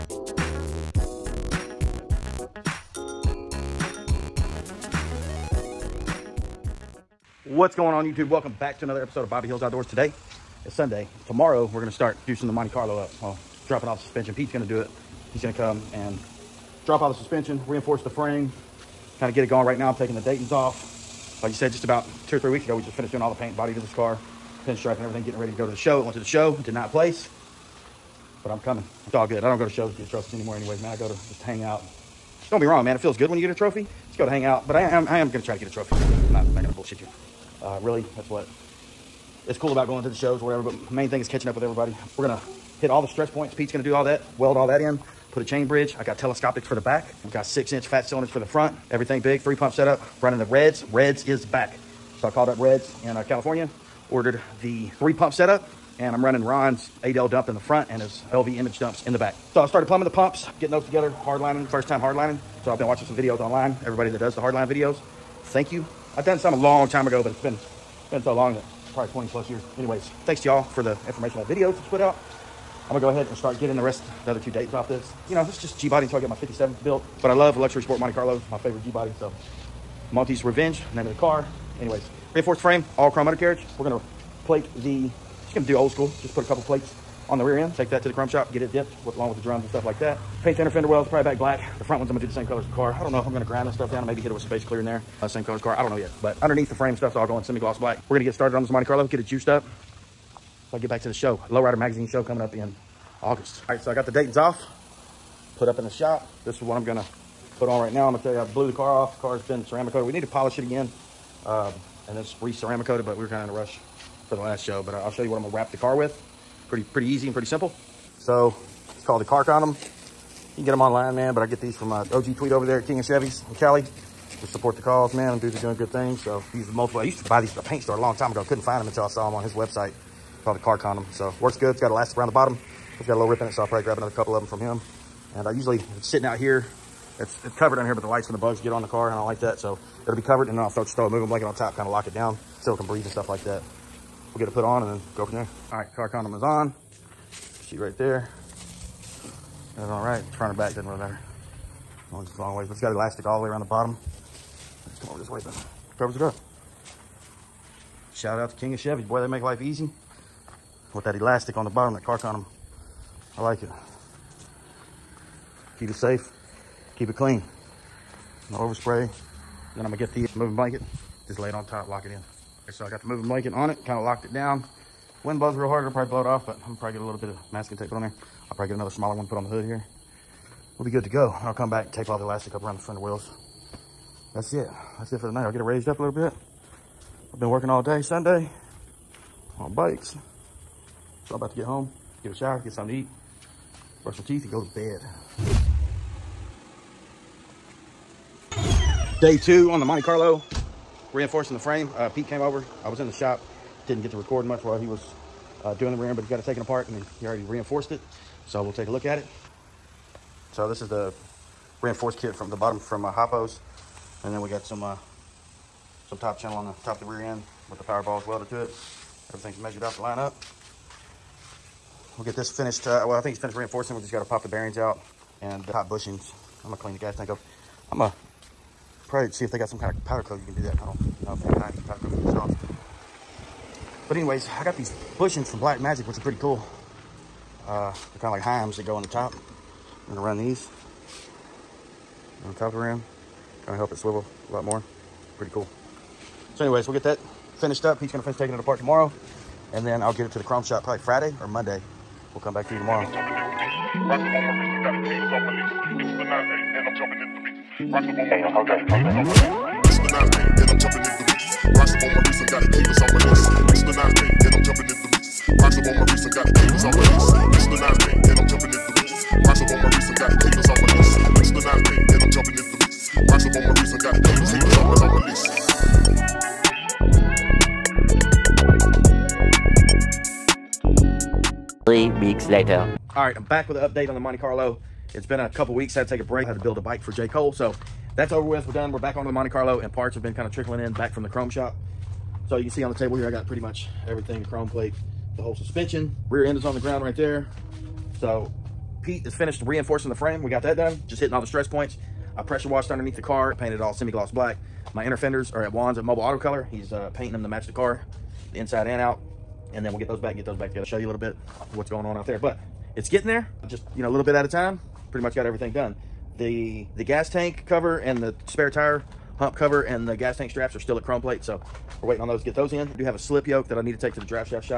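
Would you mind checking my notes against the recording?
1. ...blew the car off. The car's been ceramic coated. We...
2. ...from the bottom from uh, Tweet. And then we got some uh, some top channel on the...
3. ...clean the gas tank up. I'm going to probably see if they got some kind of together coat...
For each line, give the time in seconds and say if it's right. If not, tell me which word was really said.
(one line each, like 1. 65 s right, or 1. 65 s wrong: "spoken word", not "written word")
1. 108 s right
2. 212 s wrong: "Hoppos", not "Tweet"
3. 226 s wrong: "powder", not "together".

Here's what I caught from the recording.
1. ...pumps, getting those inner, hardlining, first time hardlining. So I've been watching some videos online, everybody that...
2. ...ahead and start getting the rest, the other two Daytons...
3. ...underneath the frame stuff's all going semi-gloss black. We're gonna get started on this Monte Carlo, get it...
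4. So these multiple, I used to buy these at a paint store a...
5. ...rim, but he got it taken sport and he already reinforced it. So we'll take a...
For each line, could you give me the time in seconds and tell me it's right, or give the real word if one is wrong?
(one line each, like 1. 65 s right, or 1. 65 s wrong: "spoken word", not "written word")
1. 60 s wrong: "together", not "inner"
2. 73 s right
3. 96 s right
4. 126 s right
5. 206 s wrong: "apart", not "sport".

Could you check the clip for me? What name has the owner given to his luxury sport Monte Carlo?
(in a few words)
Monty's Revenge.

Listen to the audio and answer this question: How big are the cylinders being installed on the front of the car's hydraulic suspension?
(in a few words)
6 inch.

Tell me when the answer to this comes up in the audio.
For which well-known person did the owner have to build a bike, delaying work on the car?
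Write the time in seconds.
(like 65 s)
287 s.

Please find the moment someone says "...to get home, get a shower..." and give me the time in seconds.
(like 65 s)
191 s.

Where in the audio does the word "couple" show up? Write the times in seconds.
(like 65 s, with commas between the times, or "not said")
86 s, 134 s, 285 s.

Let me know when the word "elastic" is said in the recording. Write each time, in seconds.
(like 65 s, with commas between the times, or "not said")
131 s, 152 s, 161 s, 182 s.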